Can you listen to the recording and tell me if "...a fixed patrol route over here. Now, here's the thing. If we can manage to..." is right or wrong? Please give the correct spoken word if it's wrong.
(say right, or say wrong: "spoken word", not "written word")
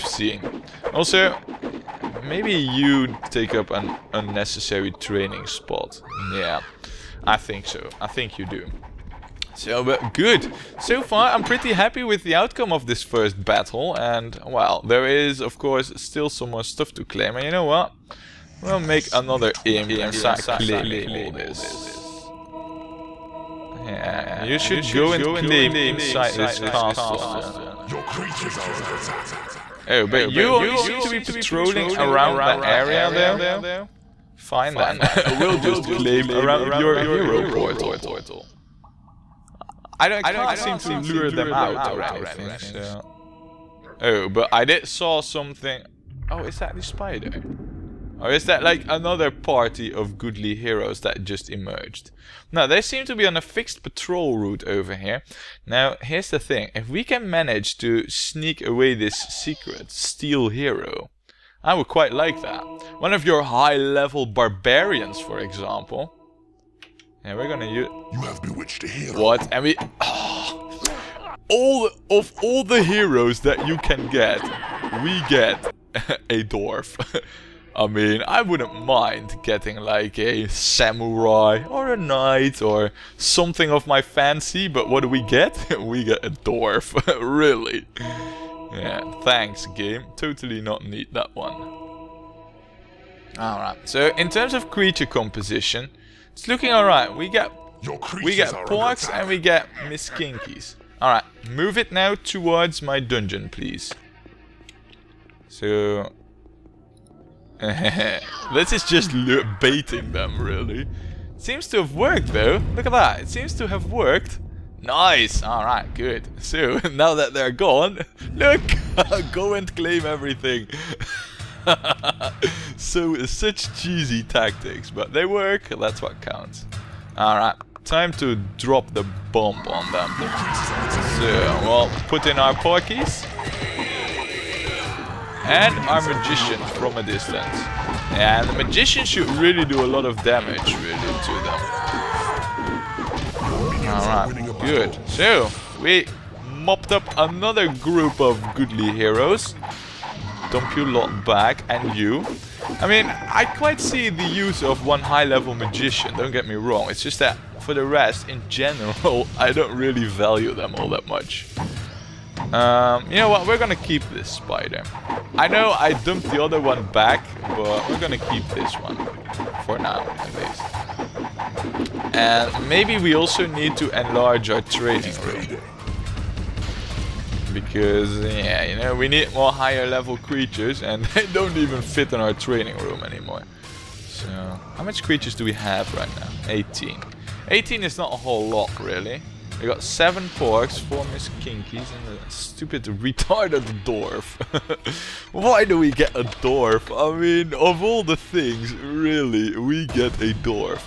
right.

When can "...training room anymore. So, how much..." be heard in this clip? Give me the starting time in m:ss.
3:02.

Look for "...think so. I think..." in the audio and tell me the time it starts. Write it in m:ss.
0:07.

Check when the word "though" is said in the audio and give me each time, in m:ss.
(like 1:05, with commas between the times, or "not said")
0:33, 1:52.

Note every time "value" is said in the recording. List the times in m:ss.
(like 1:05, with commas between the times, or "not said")
2:40.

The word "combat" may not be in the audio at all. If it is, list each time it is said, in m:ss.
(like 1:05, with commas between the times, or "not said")
not said.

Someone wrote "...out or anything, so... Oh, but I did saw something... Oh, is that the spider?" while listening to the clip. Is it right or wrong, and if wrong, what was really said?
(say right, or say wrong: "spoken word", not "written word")
right.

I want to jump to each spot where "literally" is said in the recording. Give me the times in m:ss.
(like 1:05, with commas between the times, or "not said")
not said.